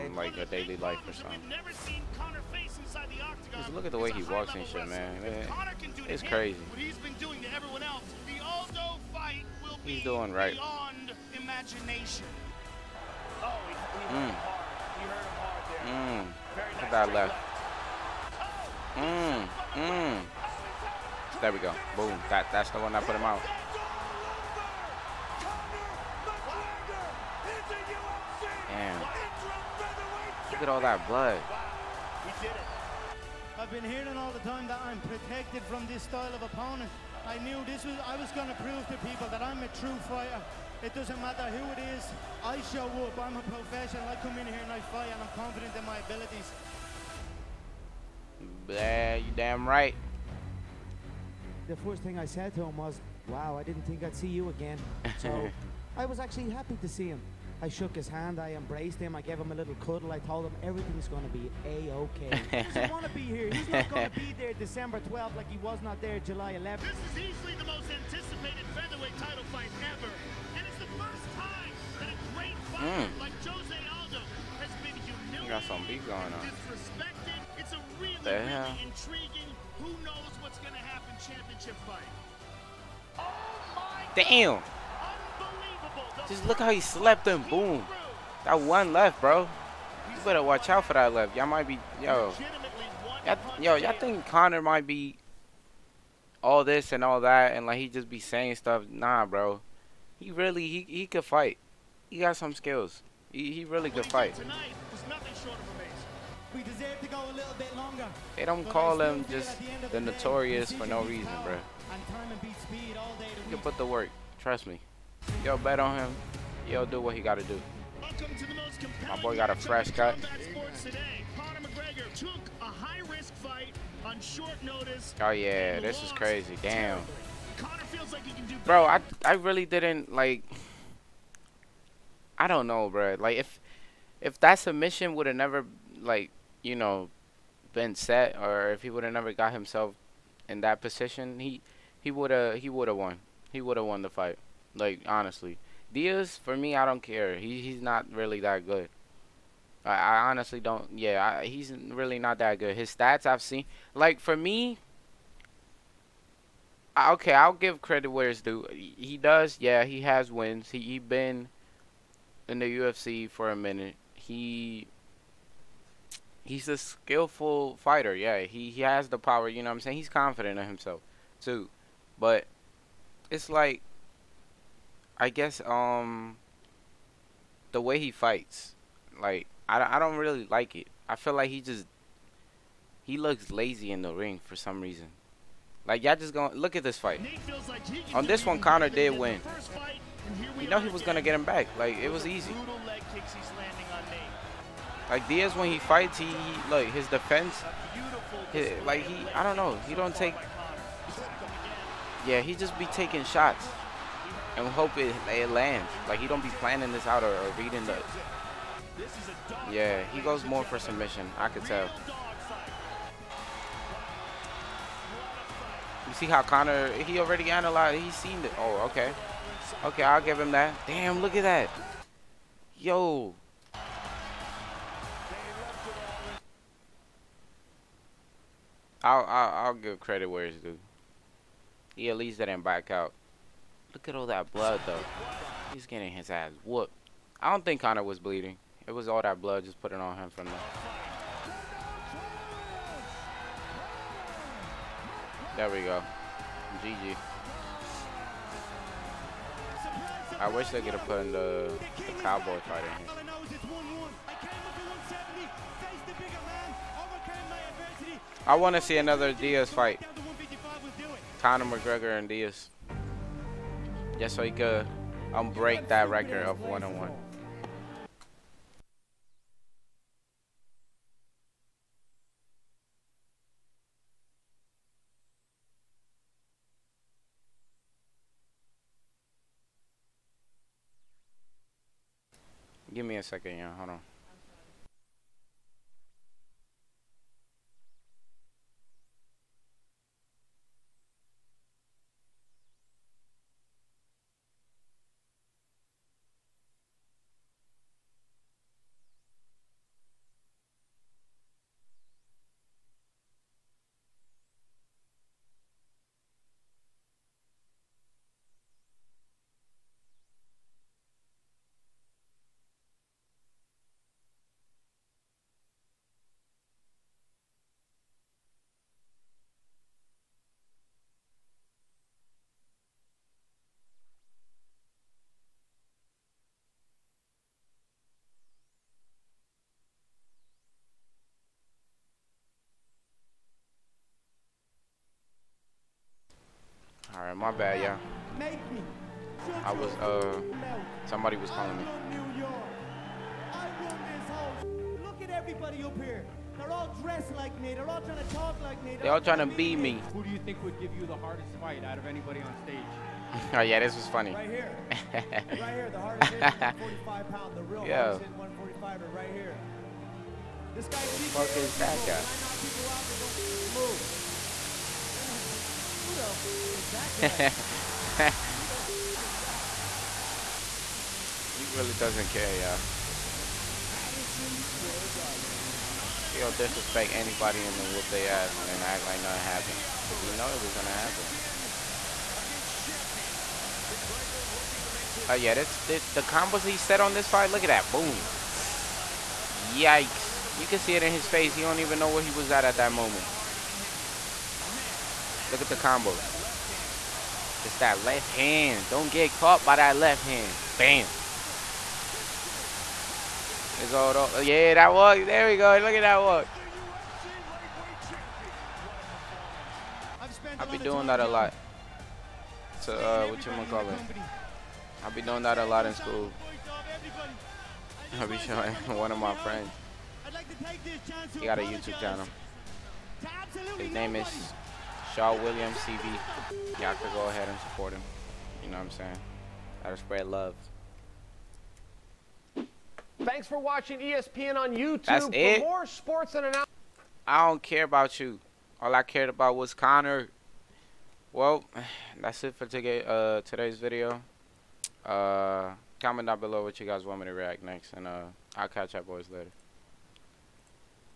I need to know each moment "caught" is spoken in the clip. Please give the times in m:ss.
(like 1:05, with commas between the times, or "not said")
6:39.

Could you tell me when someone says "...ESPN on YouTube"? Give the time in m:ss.
7:13.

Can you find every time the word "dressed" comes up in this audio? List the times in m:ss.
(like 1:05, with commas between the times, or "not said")
5:47.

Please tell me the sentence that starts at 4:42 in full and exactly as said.
Give me a second, yeah, hold on.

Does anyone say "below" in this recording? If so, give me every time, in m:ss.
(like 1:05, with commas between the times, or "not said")
7:26.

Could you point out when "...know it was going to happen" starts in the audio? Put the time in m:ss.
6:20.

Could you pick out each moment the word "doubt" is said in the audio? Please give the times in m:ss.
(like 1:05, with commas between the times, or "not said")
not said.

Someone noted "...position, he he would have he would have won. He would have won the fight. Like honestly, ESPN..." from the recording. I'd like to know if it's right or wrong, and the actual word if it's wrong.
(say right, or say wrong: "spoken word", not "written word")
wrong: "Diaz", not "ESPN".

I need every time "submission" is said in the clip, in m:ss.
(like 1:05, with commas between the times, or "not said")
2:14, 3:30.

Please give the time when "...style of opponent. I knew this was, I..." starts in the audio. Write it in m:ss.
0:36.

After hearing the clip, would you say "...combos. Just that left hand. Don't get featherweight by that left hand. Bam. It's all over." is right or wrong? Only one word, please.
wrong.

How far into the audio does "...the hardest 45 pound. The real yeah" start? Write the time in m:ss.
5:55.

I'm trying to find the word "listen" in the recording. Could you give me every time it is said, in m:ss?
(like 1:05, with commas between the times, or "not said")
not said.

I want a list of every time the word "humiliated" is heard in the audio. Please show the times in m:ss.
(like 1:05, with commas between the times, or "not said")
1:15.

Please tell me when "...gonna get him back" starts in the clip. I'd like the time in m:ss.
3:11.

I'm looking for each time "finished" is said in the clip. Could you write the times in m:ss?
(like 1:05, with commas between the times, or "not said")
not said.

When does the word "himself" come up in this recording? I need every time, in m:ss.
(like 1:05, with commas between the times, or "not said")
2:19, 2:50.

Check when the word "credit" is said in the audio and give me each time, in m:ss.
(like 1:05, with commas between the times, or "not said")
2:37, 3:49.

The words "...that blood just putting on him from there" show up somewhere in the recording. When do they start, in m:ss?
3:59.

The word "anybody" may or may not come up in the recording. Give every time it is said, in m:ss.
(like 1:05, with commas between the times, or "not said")
5:52, 6:17.